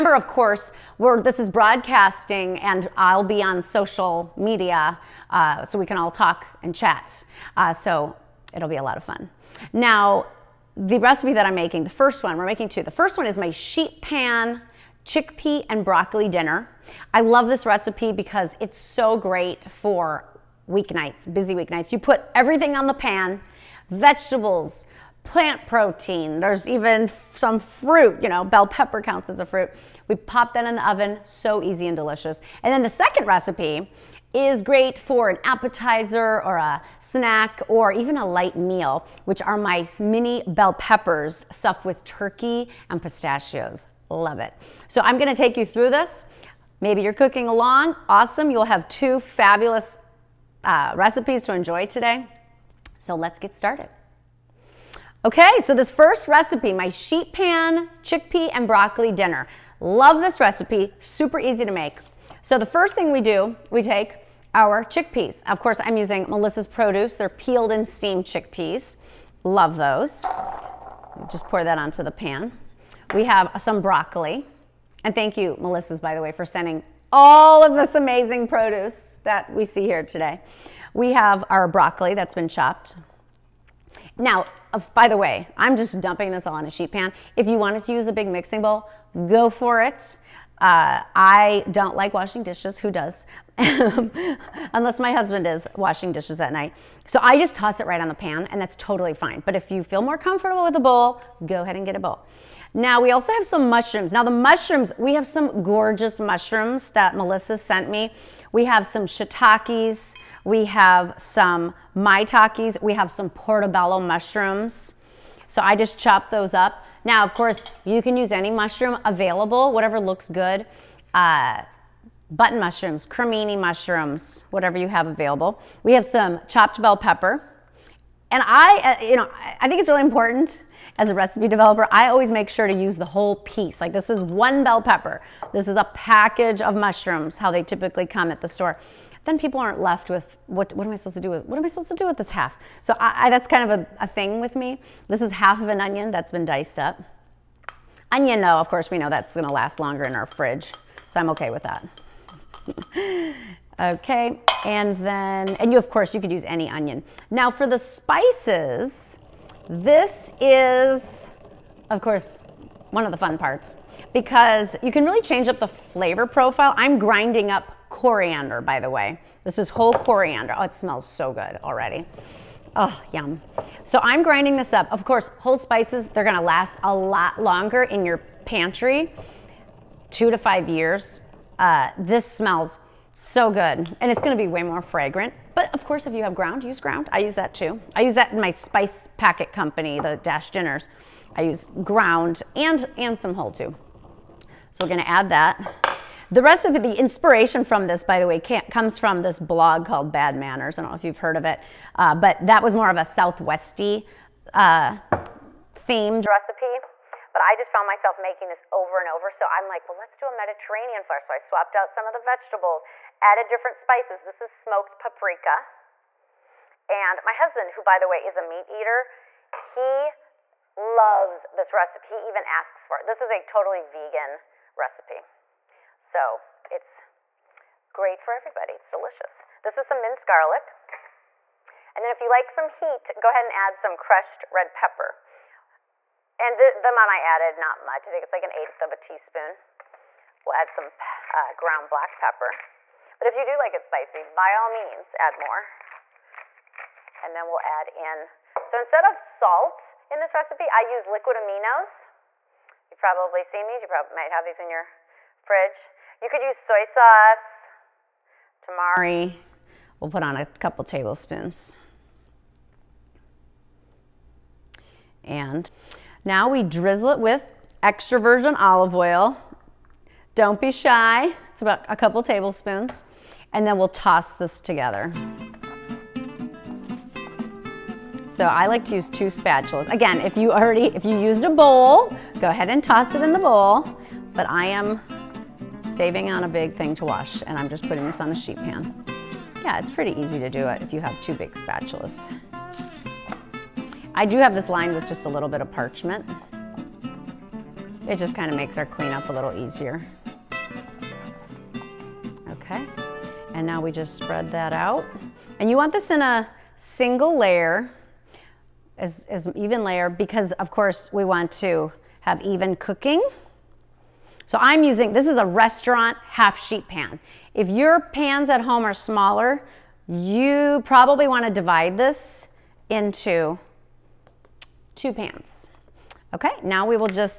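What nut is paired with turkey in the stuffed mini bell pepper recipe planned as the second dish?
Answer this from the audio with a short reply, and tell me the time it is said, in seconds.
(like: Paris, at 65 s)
Pistachios, at 42 s.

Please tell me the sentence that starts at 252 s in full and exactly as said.
You've probably seen these, you probably might have these in your fridge.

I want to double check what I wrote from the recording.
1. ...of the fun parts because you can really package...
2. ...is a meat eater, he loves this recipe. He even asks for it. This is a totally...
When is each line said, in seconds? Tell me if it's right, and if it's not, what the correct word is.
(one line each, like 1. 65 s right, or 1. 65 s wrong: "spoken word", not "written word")
1. 163 s wrong: "change", not "package"
2. 218 s right.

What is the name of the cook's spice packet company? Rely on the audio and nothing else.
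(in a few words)
Dash Dinners.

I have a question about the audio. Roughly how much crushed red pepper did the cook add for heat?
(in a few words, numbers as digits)
1/8 teaspoon.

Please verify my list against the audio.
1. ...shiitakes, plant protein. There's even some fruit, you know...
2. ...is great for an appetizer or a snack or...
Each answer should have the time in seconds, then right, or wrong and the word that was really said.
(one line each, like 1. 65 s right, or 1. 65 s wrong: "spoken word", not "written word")
1. 23 s wrong: "vegetables", not "shiitakes"
2. 34 s right.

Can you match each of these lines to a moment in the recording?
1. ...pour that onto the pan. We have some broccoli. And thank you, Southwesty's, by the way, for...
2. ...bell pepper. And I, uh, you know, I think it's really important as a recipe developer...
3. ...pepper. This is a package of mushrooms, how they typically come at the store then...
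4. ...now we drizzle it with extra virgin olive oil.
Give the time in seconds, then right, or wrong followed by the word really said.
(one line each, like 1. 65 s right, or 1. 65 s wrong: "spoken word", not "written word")
1. 71 s wrong: "Melissa", not "Southwesty"
2. 126 s right
3. 134 s right
4. 266 s right.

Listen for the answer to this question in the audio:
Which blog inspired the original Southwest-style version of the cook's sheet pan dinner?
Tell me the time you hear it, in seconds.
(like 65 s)
200 s.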